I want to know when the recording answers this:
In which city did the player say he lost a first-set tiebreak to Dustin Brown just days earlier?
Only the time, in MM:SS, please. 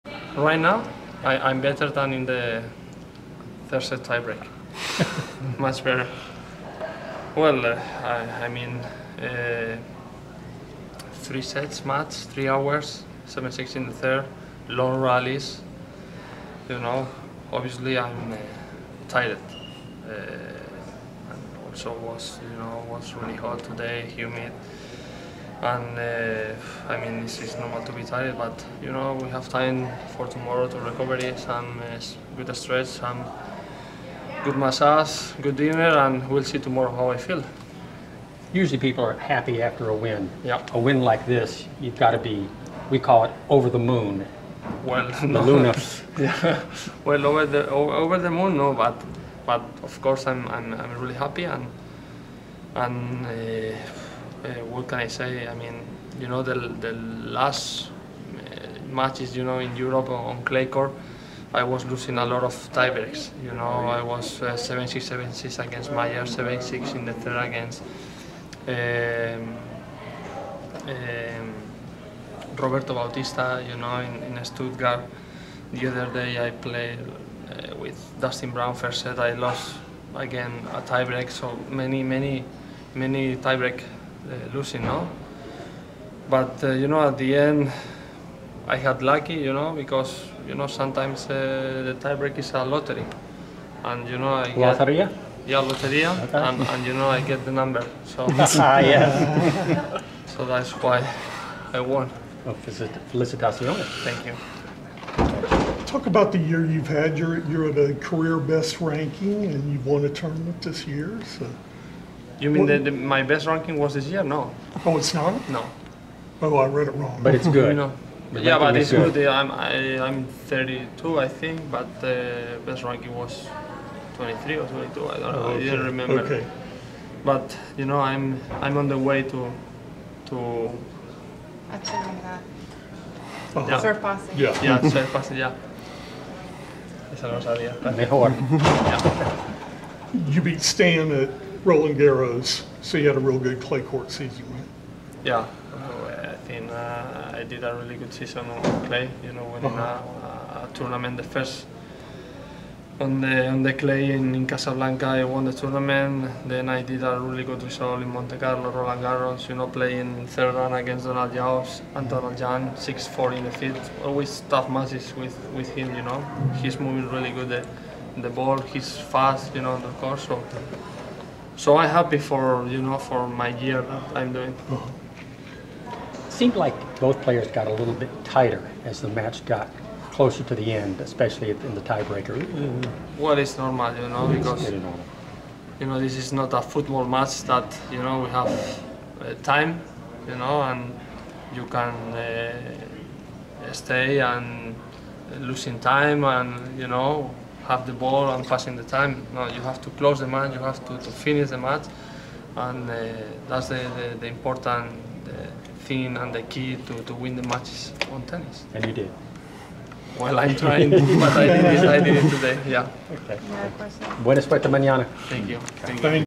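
01:14.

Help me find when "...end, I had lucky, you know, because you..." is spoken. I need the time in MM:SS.
01:27.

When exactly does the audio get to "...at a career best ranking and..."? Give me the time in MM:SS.
01:47.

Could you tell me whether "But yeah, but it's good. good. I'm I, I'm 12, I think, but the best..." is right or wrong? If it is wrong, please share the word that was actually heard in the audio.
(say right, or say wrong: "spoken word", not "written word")
wrong: "32", not "12".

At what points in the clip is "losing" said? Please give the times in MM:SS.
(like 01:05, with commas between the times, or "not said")
01:01, 01:24, 03:15.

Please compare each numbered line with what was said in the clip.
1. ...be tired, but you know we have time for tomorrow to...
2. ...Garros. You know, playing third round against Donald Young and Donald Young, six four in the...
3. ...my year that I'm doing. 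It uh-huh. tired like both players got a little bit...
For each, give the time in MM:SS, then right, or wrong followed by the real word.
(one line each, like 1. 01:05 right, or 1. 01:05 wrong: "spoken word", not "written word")
1. 00:27 right
2. 02:39 right
3. 02:53 wrong: "seemed", not "tired".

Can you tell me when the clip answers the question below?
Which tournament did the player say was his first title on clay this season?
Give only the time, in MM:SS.
02:34.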